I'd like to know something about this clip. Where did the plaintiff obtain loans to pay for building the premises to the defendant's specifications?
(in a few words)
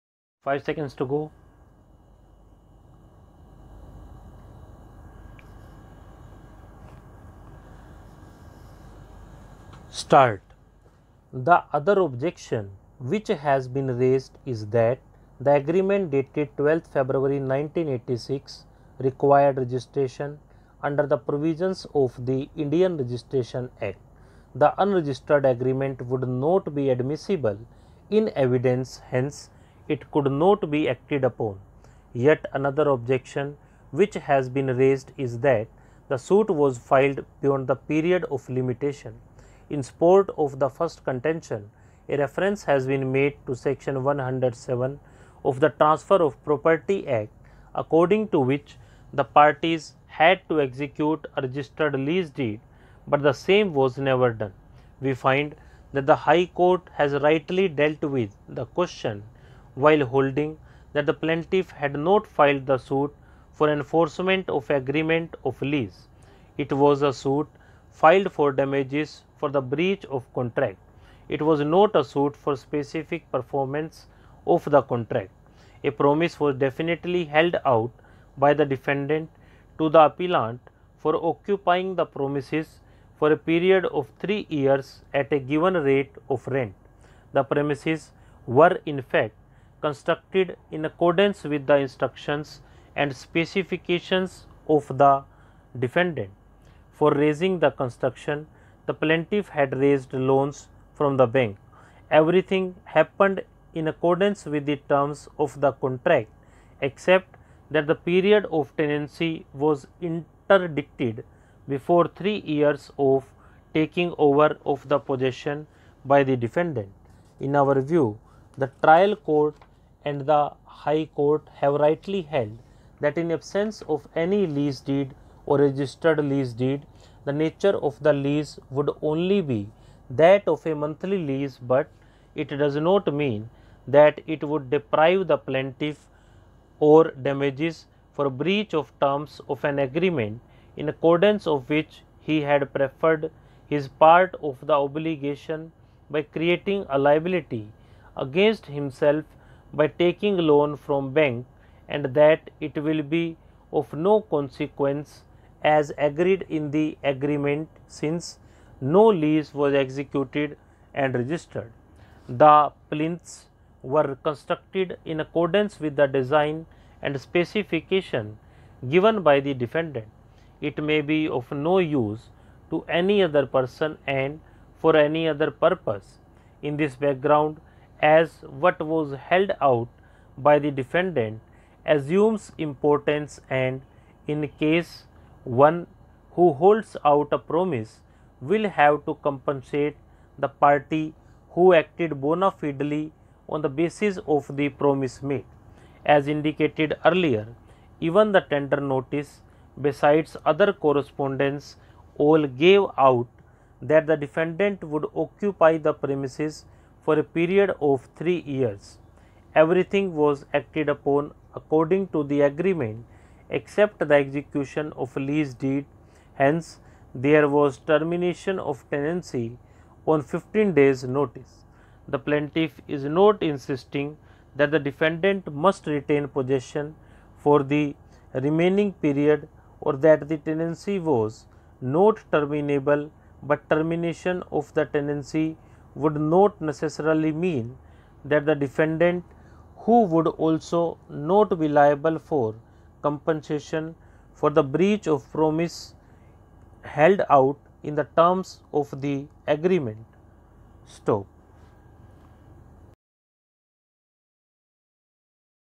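The bank.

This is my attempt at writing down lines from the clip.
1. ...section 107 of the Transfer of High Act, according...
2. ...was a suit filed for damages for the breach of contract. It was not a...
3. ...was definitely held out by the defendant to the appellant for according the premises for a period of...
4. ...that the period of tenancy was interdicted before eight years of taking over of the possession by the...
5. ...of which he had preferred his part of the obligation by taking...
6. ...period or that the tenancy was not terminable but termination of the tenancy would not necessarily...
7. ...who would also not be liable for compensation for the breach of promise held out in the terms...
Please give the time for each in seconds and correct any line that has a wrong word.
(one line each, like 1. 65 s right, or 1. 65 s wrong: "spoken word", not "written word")
1. 43 s wrong: "Property", not "High"
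2. 66 s right
3. 76 s wrong: "occupying", not "according"
4. 107 s wrong: "three", not "eight"
5. 141 s wrong: "creating", not "taking"
6. 229 s right
7. 239 s right.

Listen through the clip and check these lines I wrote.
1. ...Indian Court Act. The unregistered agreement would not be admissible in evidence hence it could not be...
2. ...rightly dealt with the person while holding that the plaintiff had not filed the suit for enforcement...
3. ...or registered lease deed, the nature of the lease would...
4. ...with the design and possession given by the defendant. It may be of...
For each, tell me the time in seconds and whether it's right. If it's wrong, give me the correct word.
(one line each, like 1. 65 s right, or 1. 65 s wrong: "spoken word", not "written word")
1. 22 s wrong: "Registration", not "Court"
2. 57 s wrong: "question", not "person"
3. 125 s right
4. 165 s wrong: "specification", not "possession".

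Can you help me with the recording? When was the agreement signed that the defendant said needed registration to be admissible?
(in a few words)
12 February 1986.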